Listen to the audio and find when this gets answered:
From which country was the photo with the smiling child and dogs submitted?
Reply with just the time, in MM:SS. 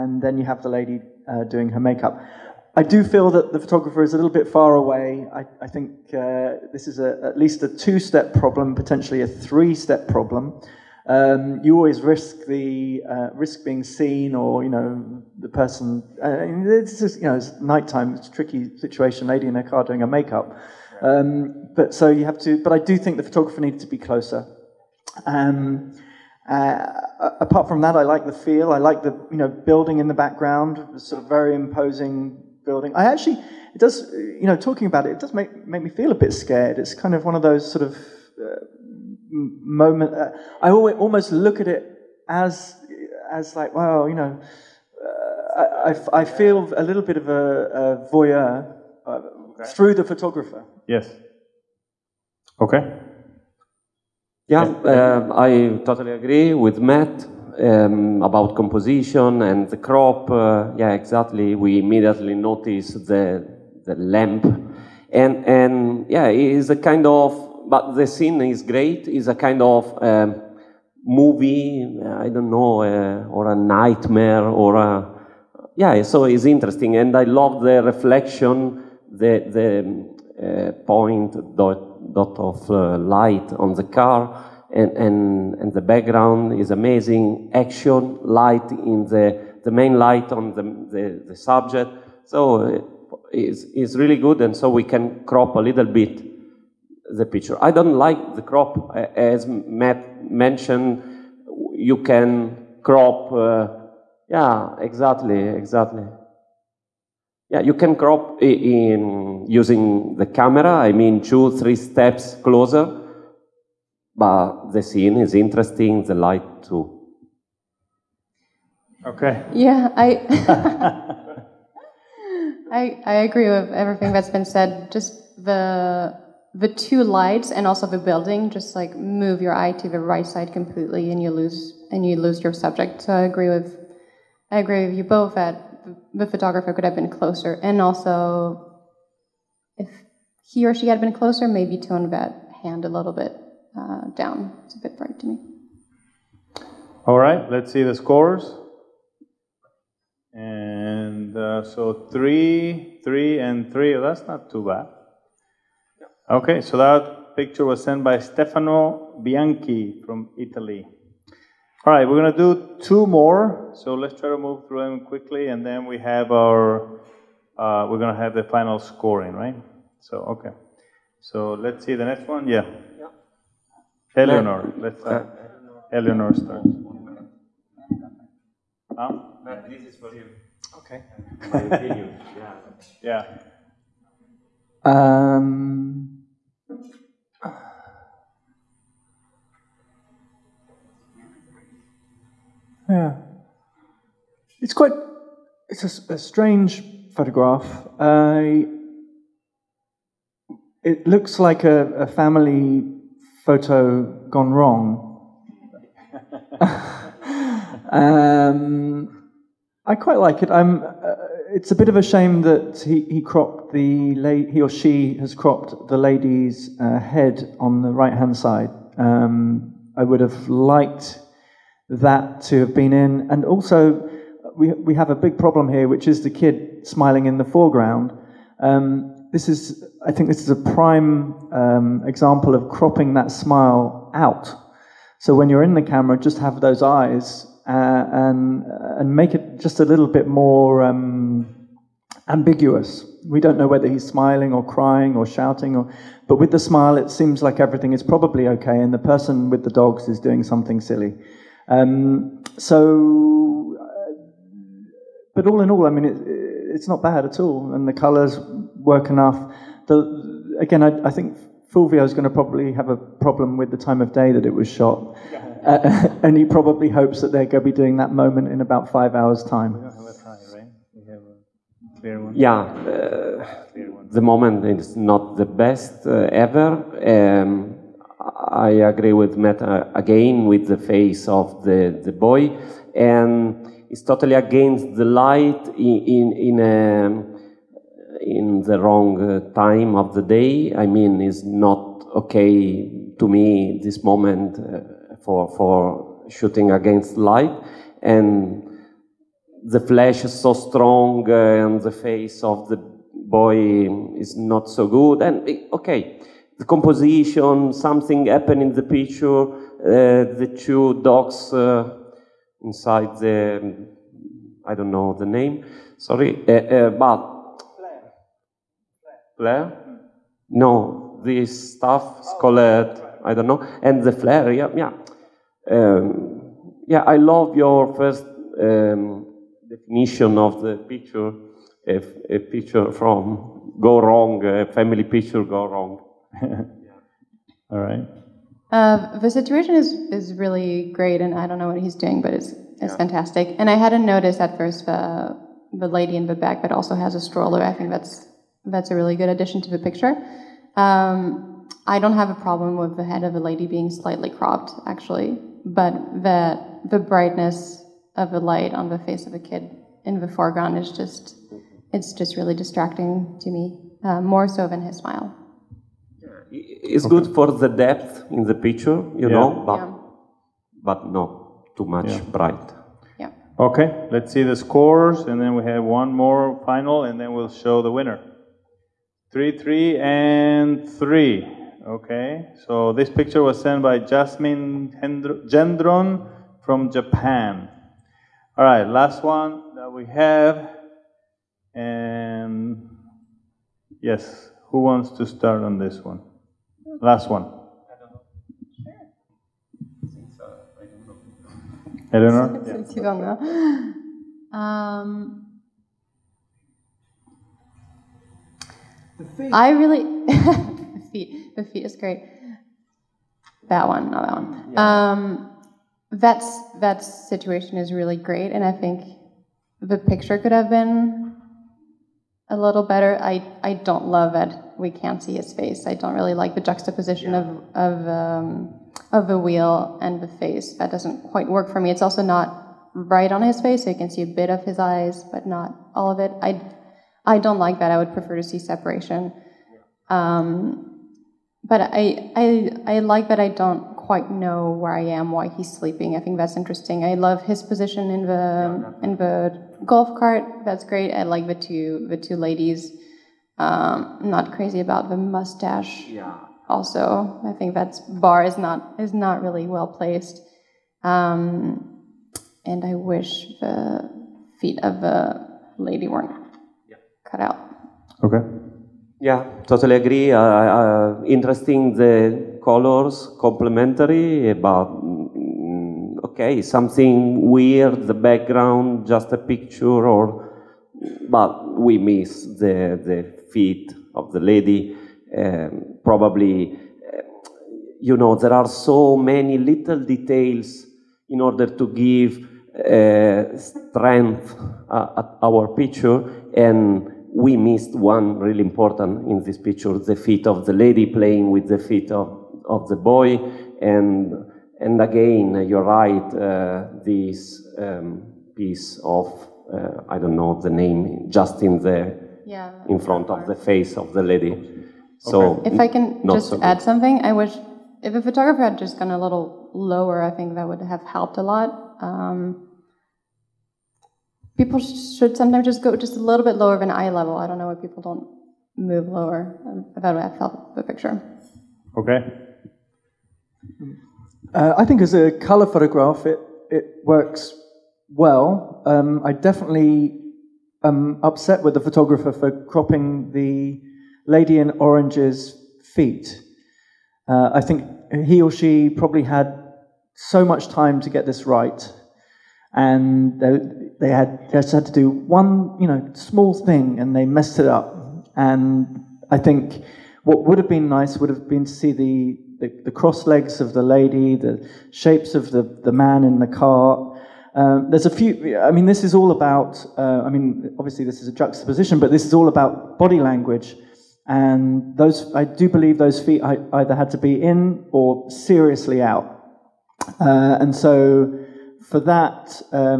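06:26.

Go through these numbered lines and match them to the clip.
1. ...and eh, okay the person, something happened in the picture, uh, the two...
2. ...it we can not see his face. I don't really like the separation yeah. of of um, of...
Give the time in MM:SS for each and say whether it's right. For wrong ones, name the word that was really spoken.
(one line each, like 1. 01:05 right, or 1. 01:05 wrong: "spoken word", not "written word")
1. 05:05 wrong: "composition", not "person"
2. 07:04 wrong: "juxtaposition", not "separation".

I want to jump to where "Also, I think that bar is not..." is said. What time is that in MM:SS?
07:36.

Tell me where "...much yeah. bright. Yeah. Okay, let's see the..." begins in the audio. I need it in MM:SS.
06:11.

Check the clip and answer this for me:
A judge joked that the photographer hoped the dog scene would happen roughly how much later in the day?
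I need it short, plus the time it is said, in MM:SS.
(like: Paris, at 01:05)
5 hours, at 04:28.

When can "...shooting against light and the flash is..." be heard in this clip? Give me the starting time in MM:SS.
04:56.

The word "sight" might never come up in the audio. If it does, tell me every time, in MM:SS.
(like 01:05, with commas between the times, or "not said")
not said.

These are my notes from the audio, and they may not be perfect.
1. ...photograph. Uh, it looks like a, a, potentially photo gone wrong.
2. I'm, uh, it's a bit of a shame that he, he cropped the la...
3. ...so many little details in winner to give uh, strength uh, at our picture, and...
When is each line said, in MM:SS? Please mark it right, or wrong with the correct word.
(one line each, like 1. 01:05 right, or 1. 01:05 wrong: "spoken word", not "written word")
1. 03:17 wrong: "family", not "potentially"
2. 03:30 right
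3. 08:08 wrong: "order", not "winner".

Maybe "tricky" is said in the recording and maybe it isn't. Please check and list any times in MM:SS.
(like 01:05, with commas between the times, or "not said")
00:18.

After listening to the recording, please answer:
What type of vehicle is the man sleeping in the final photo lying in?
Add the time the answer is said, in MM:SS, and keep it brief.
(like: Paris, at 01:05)
golf cart, at 07:29.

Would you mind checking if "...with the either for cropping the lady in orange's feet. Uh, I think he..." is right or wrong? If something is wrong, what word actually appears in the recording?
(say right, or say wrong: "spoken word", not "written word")
wrong: "photographer", not "either".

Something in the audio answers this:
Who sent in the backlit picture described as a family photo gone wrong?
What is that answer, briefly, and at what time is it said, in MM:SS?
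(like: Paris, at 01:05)
Jasmin Gendron, at 06:23.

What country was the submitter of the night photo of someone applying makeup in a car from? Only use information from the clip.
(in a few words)
Italy.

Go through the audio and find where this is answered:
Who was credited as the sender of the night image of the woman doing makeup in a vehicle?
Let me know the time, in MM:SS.
02:38.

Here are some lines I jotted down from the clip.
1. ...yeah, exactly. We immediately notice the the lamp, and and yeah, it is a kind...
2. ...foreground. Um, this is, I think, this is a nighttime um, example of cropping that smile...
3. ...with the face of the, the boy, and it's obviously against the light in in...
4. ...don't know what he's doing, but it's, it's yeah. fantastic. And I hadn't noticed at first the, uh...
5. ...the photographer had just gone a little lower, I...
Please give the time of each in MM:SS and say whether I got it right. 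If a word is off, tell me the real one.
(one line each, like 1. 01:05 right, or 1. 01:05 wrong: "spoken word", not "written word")
1. 01:00 right
2. 03:47 wrong: "prime", not "nighttime"
3. 04:40 wrong: "totally", not "obviously"
4. 05:41 right
5. 08:38 right.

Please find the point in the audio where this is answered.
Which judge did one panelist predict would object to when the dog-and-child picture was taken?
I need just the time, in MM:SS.
04:21.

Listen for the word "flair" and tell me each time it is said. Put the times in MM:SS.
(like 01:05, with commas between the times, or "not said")
05:19, 05:24.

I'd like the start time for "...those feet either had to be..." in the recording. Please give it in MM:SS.
09:35.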